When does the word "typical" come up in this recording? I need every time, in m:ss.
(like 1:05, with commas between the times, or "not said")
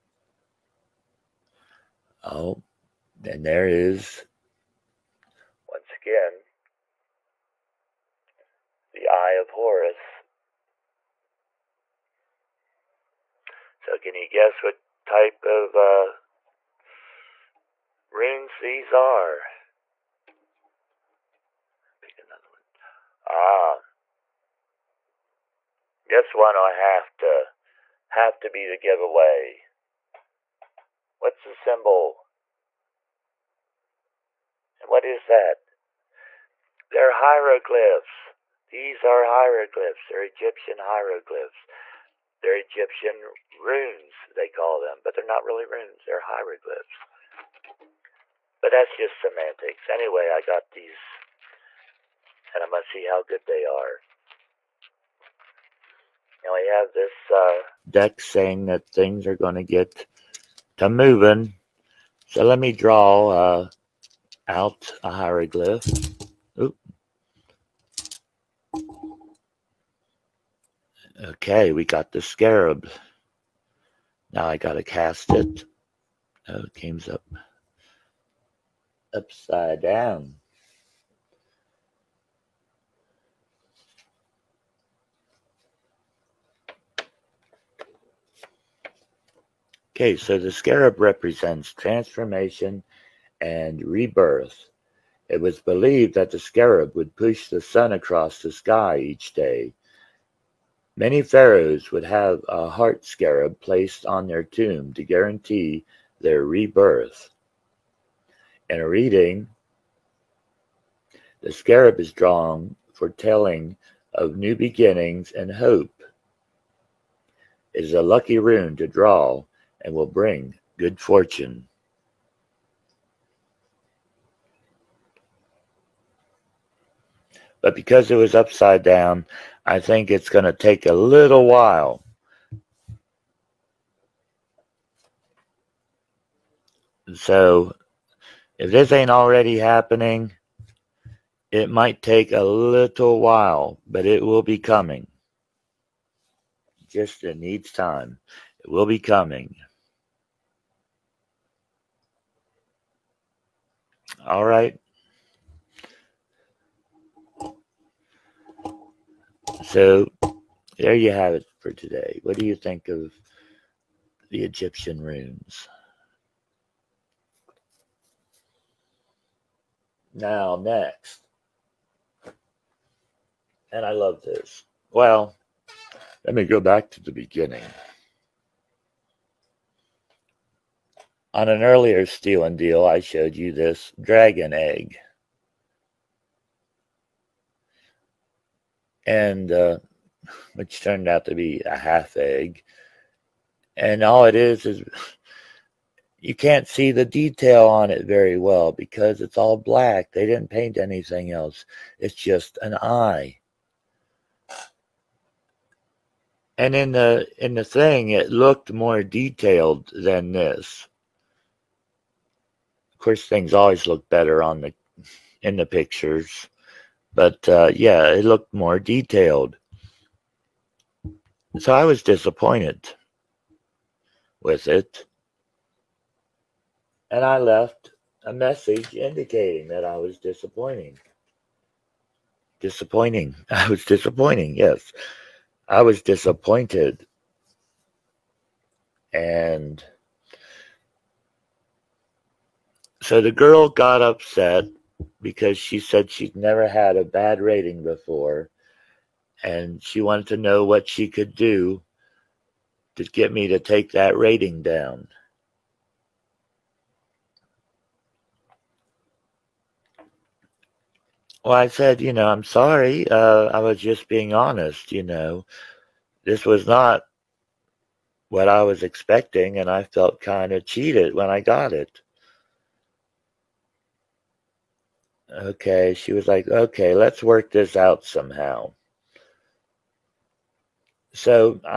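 not said.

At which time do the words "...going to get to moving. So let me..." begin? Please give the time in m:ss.
0:59.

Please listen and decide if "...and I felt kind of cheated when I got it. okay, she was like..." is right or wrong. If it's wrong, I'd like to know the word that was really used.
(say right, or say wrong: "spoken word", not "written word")
right.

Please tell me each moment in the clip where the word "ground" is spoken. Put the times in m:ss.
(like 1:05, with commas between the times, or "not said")
not said.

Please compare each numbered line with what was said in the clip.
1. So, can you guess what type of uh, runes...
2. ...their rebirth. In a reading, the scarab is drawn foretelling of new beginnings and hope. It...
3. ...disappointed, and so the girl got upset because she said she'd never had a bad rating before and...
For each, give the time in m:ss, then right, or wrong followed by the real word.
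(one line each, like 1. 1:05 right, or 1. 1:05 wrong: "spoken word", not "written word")
1. 0:13 right
2. 1:46 right
3. 3:56 right.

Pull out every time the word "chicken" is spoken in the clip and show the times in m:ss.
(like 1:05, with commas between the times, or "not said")
not said.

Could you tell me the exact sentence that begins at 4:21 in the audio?
Well, I said, you know, I'm sorry.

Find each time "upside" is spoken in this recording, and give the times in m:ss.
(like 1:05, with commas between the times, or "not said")
1:19, 2:08.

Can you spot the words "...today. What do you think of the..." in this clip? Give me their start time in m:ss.
2:41.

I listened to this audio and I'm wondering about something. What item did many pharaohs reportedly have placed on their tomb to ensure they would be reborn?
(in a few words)
Heart scarab.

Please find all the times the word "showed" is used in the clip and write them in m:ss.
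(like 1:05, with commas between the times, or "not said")
3:02.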